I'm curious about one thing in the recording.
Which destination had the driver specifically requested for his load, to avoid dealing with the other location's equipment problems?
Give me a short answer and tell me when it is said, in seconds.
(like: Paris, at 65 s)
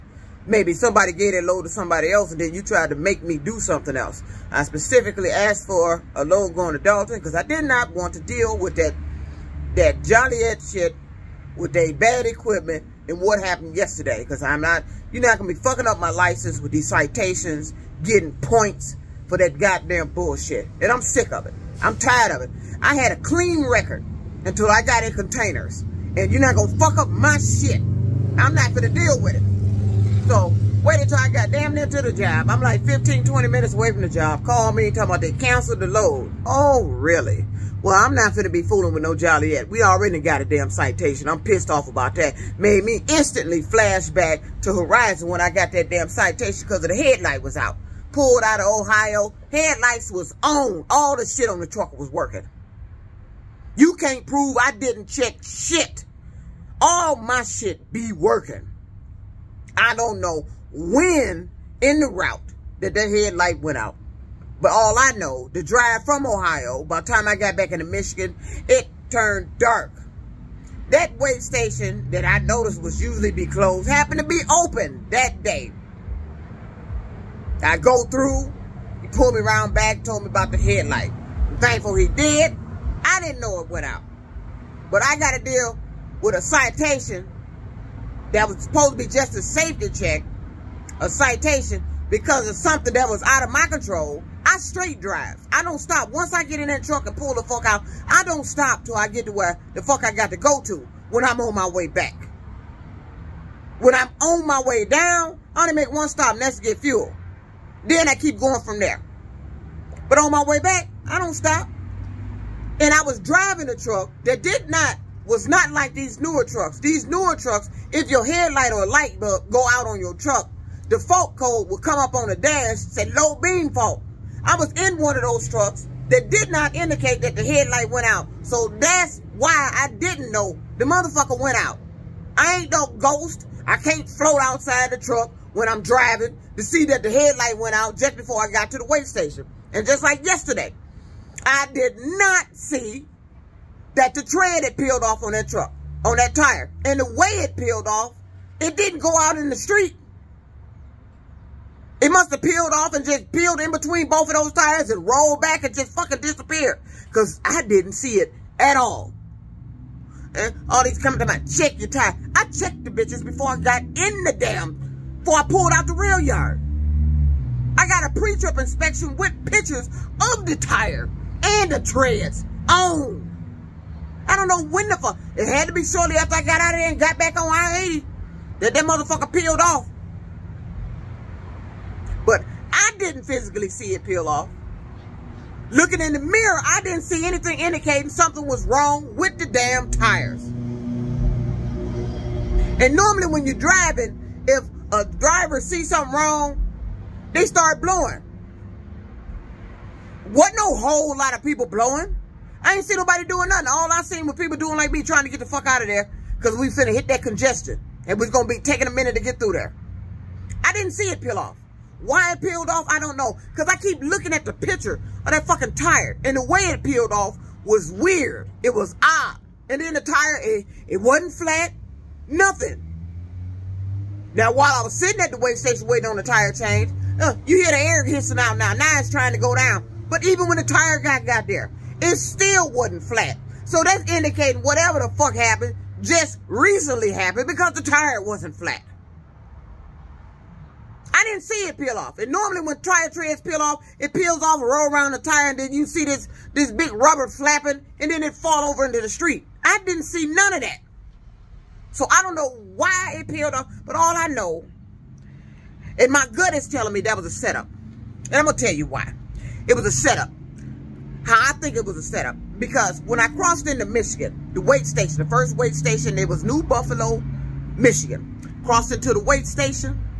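Dalton, at 6 s.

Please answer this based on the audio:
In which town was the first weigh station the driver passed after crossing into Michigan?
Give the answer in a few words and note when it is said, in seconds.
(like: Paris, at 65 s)
New Buffalo, at 266 s.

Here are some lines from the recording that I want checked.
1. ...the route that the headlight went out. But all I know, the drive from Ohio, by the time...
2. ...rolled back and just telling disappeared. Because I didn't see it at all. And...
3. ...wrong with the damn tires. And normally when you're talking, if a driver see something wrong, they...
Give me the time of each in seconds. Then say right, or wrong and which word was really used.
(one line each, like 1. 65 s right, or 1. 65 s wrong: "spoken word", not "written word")
1. 62 s right
2. 155 s wrong: "fucking", not "telling"
3. 188 s wrong: "driving", not "talking".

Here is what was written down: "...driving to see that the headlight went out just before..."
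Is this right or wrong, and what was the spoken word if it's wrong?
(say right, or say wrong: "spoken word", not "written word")
right.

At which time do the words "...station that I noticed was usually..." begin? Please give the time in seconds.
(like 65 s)
71 s.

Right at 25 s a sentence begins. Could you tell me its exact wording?
And you're not going to fuck up my shit.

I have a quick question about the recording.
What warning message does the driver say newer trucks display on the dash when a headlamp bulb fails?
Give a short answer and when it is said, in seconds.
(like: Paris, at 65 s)
low beam fault, at 123 s.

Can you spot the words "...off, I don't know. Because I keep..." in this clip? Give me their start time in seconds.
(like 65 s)
212 s.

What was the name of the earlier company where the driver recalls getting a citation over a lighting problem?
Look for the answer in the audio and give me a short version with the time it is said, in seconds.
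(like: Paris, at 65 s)
Horizon, at 44 s.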